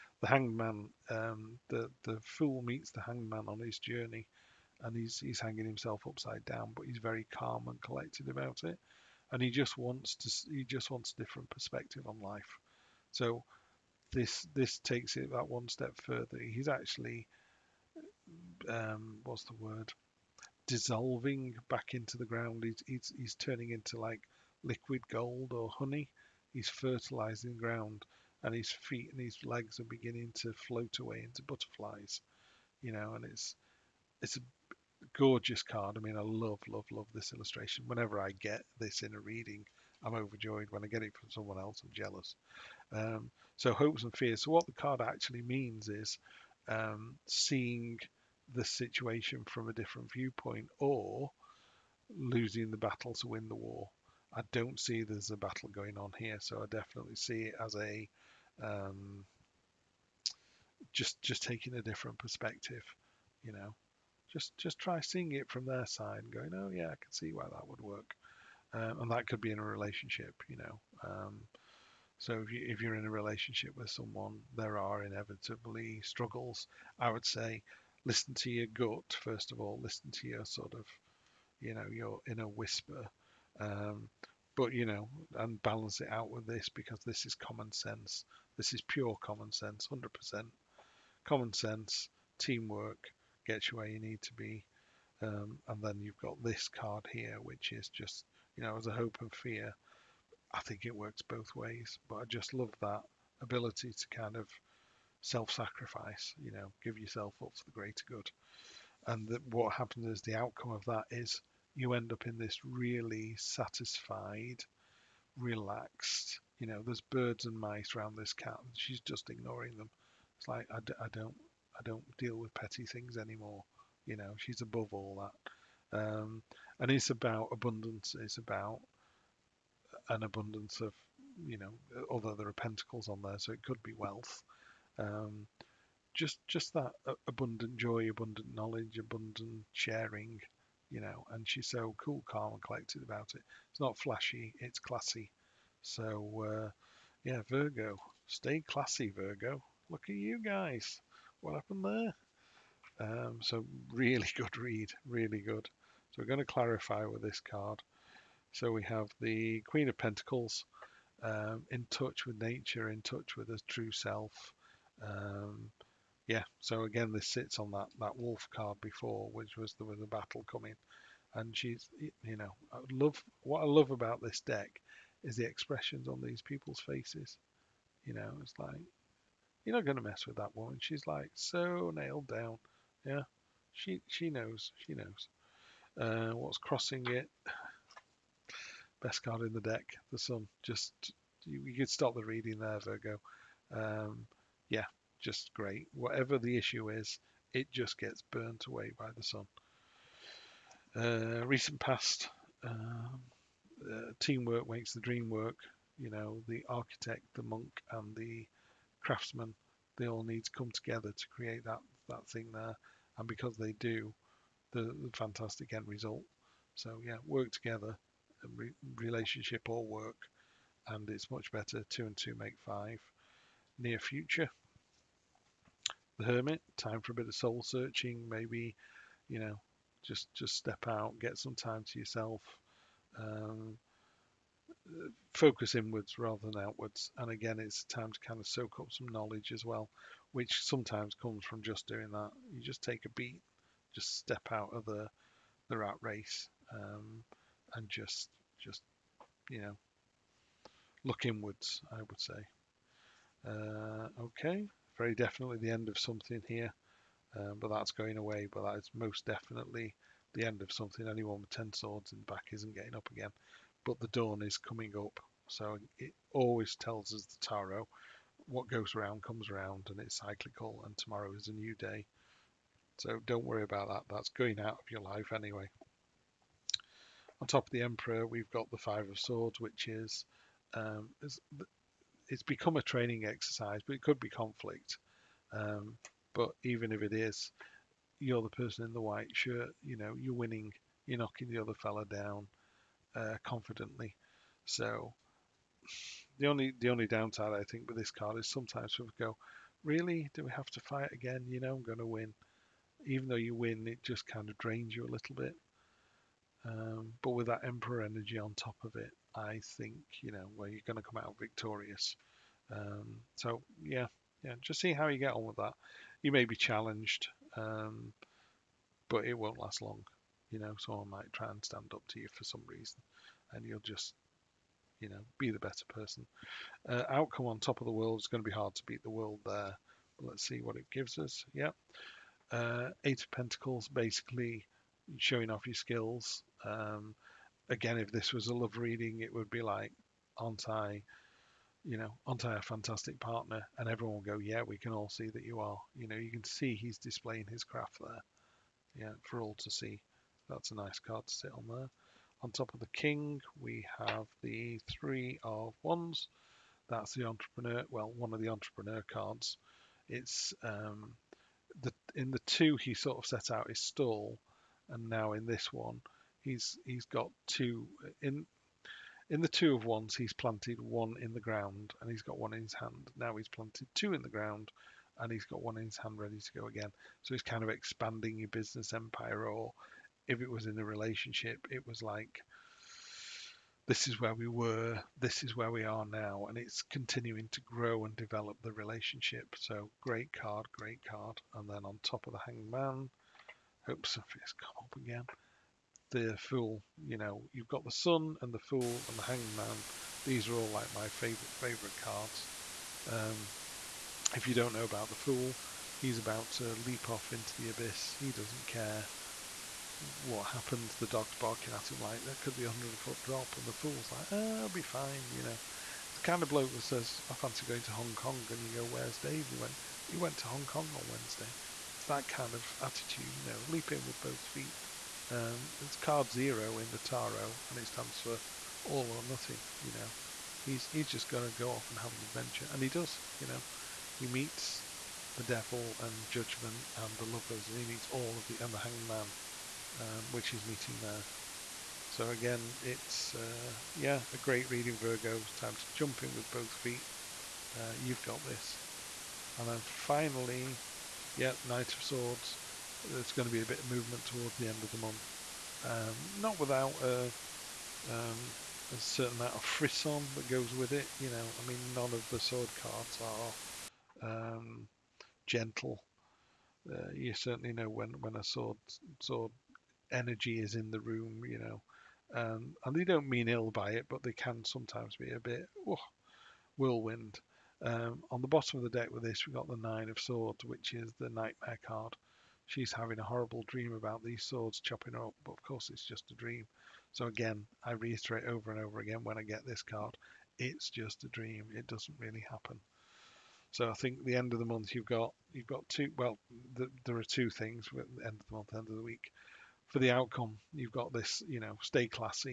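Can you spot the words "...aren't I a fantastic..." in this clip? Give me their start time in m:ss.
5:42.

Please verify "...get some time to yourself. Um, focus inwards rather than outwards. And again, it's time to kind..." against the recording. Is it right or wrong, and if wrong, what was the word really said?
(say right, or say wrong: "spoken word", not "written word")
right.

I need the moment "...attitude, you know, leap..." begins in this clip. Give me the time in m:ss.
7:02.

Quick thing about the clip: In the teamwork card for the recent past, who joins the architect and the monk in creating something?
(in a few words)
the craftsmen.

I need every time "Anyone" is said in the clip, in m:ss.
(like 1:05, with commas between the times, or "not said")
4:21.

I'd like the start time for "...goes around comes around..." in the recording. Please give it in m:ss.
4:28.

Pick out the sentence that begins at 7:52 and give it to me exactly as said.
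Um, and they don't mean ill by it, but they can sometimes be a bit oh, whirlwind.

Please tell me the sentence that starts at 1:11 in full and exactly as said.
Um, so if you if you're in a relationship with someone, there are inevitably struggles.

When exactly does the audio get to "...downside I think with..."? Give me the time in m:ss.
4:57.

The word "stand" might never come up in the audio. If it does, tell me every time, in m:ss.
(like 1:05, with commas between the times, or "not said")
5:21, 7:07.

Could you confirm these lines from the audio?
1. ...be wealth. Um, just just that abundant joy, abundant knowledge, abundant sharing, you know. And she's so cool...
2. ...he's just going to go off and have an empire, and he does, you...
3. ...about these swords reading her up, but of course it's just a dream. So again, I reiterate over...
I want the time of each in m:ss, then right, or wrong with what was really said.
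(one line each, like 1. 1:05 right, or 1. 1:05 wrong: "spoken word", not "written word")
1. 2:13 right
2. 7:10 wrong: "adventure", not "empire"
3. 8:03 wrong: "chopping", not "reading".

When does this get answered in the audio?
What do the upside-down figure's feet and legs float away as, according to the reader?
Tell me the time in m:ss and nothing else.
0:31.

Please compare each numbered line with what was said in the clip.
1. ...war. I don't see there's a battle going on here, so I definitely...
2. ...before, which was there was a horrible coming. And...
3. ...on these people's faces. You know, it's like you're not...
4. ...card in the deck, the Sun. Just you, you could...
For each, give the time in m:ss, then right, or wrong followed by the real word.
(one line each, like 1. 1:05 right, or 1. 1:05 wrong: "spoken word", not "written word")
1. 0:53 right
2. 2:48 wrong: "battle", not "horrible"
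3. 2:56 right
4. 3:09 right.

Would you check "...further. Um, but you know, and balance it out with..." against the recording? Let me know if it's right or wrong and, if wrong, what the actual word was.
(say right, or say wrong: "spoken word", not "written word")
wrong: "whisper", not "further".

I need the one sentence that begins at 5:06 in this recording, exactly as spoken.
Um, but with that Emperor energy on top of it, I think you know where well, you're going to come out victorious.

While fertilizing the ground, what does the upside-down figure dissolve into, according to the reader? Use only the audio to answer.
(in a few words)
liquid gold or honey.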